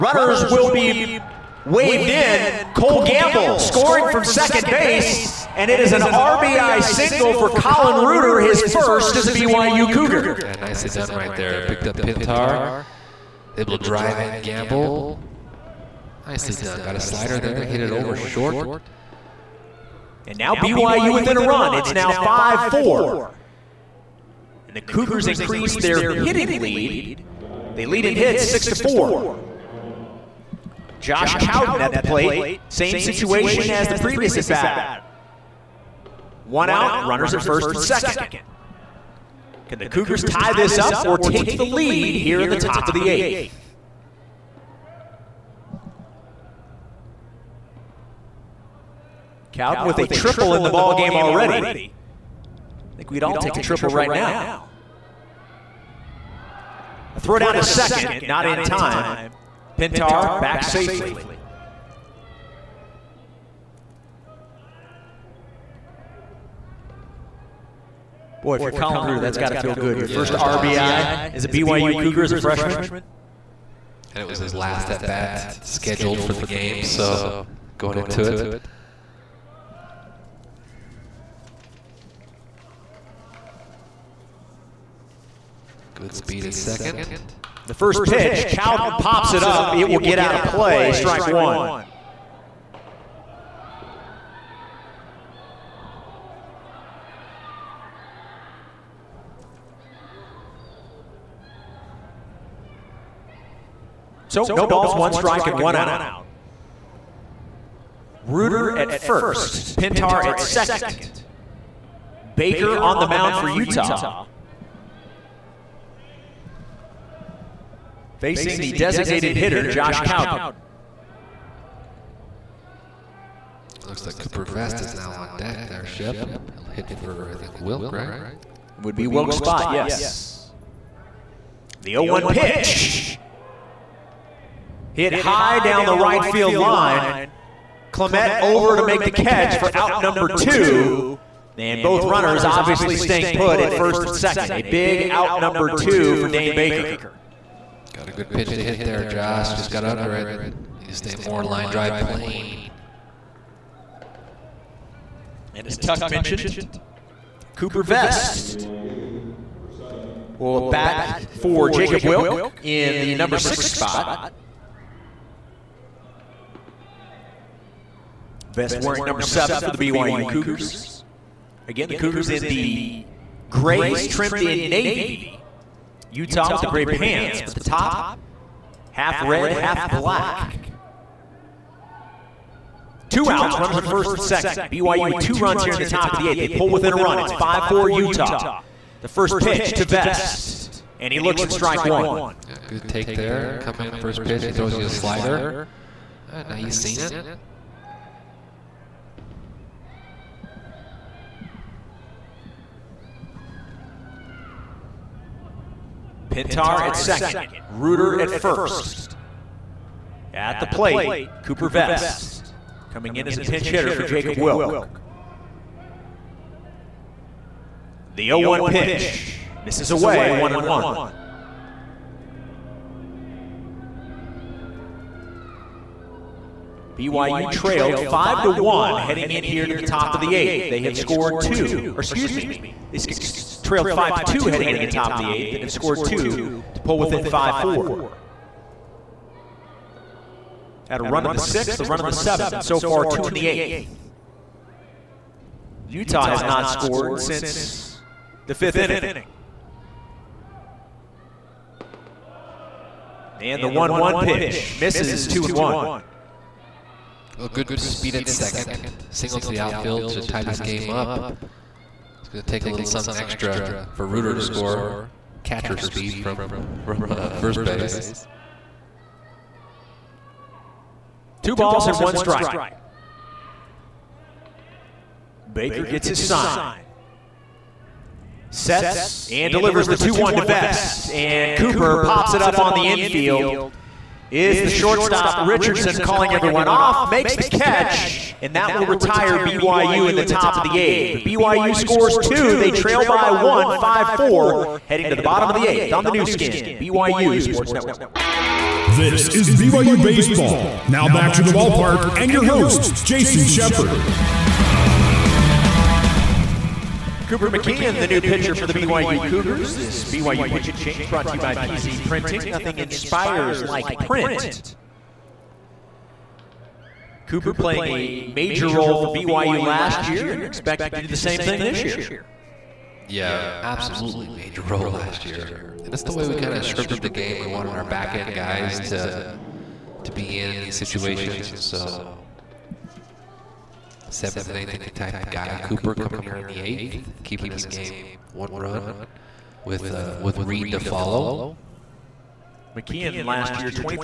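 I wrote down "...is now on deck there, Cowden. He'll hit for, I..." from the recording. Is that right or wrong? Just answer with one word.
wrong.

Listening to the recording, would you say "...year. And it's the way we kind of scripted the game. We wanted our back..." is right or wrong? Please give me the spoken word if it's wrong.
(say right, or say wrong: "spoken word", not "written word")
right.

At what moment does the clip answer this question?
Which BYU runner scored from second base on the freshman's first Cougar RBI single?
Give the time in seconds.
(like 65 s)
2 s.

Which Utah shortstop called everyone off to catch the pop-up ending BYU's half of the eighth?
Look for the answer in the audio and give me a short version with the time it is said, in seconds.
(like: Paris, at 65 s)
Richardson, at 285 s.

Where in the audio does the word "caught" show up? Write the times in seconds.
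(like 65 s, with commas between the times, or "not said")
not said.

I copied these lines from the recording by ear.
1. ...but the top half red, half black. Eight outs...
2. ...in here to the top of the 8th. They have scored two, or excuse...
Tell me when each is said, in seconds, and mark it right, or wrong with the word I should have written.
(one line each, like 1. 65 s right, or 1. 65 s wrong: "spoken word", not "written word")
1. 177 s wrong: "Two", not "Eight"
2. 229 s right.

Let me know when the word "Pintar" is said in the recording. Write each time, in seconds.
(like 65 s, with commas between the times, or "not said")
12 s, 59 s, 109 s, 206 s.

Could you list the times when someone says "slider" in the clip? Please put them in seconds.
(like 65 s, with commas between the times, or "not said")
17 s, 194 s.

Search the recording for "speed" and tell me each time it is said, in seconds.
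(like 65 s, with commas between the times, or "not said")
86 s, 257 s, 265 s.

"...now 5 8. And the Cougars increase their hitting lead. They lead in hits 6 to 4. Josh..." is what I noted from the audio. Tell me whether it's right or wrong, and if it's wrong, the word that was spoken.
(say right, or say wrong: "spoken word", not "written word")
wrong: "4", not "8".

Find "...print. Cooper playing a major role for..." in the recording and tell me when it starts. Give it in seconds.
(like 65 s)
313 s.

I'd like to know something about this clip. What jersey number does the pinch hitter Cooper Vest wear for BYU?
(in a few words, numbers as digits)
7.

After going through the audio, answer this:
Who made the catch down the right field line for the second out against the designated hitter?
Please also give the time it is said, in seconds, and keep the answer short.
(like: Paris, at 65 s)
Clement, at 137 s.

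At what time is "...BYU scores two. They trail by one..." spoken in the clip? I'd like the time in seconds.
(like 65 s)
291 s.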